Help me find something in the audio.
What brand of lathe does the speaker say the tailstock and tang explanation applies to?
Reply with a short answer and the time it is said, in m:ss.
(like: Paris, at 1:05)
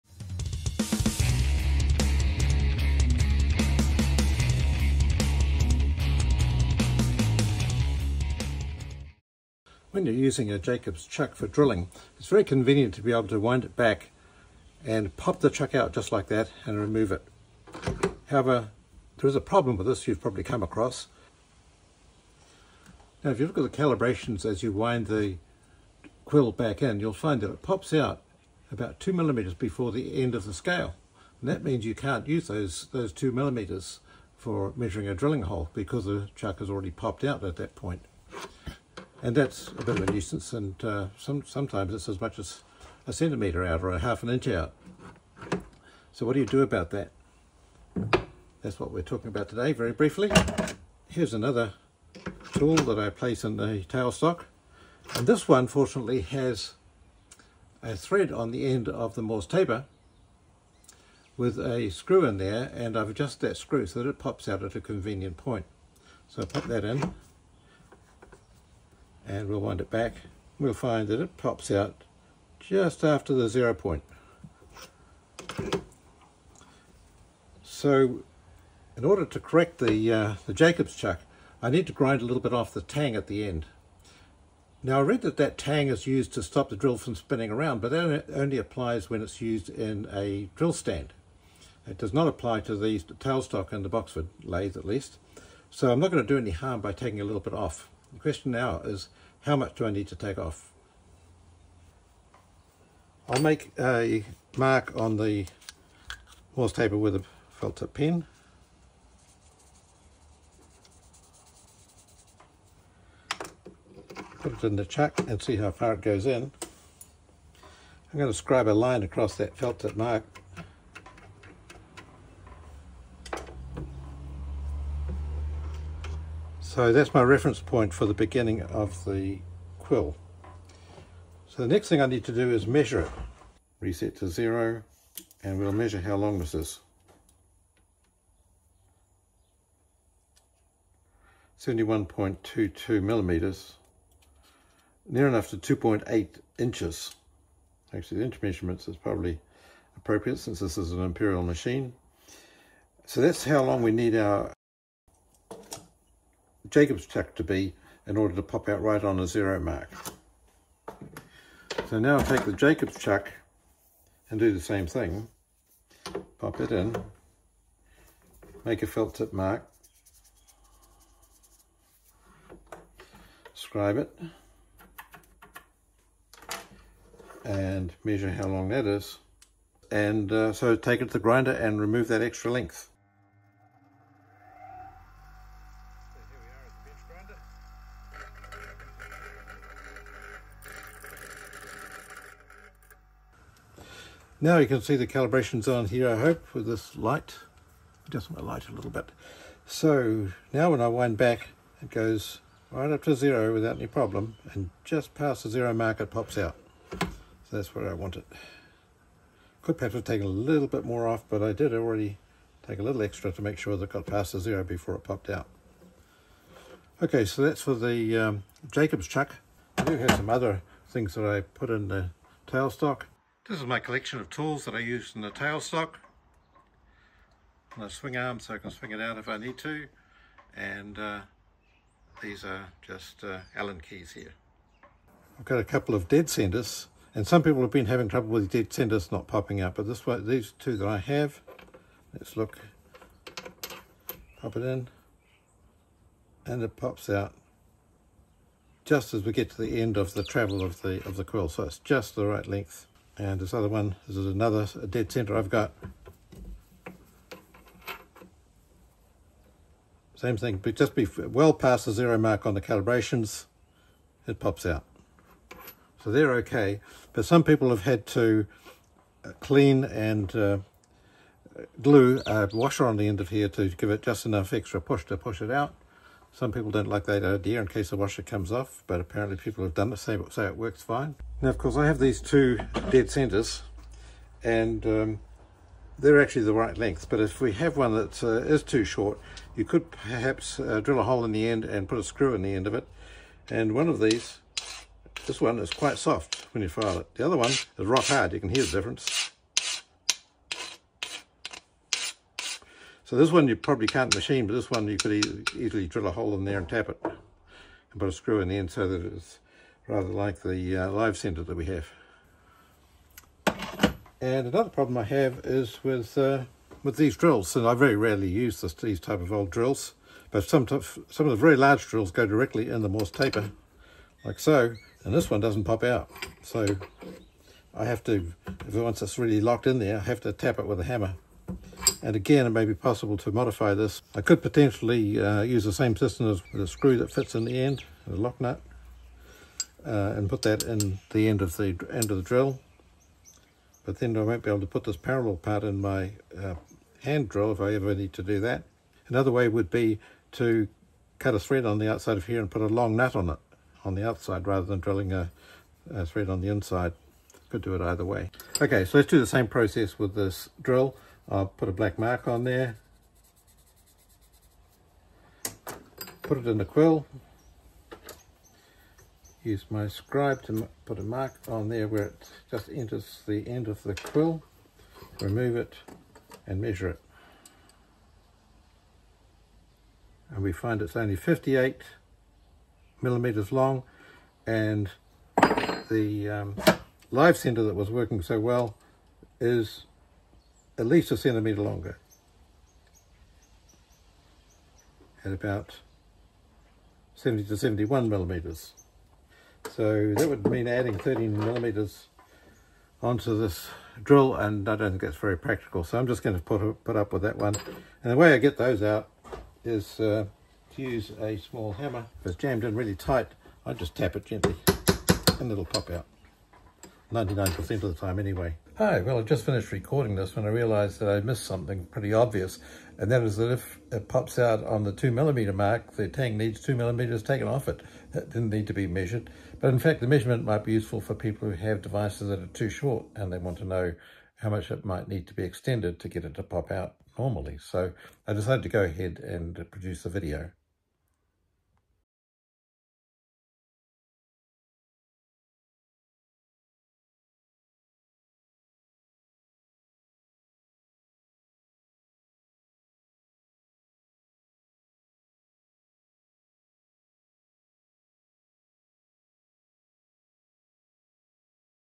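Boxford, at 1:33.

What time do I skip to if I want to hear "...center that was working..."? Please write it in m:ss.
6:27.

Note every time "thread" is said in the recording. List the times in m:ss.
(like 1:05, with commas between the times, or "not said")
0:57, 5:51, 5:56.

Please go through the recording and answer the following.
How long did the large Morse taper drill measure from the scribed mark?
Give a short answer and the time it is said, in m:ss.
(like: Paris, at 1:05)
58 millimeters, at 6:21.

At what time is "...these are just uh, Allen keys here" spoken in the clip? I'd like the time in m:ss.
3:52.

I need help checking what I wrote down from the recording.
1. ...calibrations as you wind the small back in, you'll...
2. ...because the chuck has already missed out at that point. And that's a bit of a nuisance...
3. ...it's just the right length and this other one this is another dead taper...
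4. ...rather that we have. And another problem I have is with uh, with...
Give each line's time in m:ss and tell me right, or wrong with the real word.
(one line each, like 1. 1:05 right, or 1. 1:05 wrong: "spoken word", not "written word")
1. 0:23 wrong: "quill", not "small"
2. 0:35 wrong: "popped", not "missed"
3. 4:11 wrong: "center", not "taper"
4. 5:11 wrong: "center", not "rather".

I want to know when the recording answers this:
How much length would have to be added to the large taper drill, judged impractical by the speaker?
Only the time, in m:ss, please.
6:40.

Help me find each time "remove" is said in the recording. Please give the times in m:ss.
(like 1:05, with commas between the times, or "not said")
0:16, 3:01, 6:15.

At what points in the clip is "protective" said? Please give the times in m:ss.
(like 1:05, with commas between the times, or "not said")
not said.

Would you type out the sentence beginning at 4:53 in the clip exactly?
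And one of these, this one is quite soft when you file it.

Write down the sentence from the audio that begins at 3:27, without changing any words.
So that's where I want it.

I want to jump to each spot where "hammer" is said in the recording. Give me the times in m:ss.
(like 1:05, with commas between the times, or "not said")
5:30, 6:51.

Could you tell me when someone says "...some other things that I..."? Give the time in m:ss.
3:40.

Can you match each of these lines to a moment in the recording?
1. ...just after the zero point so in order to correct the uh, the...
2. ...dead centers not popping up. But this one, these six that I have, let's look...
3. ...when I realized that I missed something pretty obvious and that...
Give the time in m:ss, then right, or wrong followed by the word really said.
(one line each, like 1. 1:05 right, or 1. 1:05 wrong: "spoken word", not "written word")
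1. 1:12 right
2. 3:58 wrong: "two", not "six"
3. 7:00 right.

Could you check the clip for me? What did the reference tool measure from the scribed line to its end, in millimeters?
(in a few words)
71.22 millimeters.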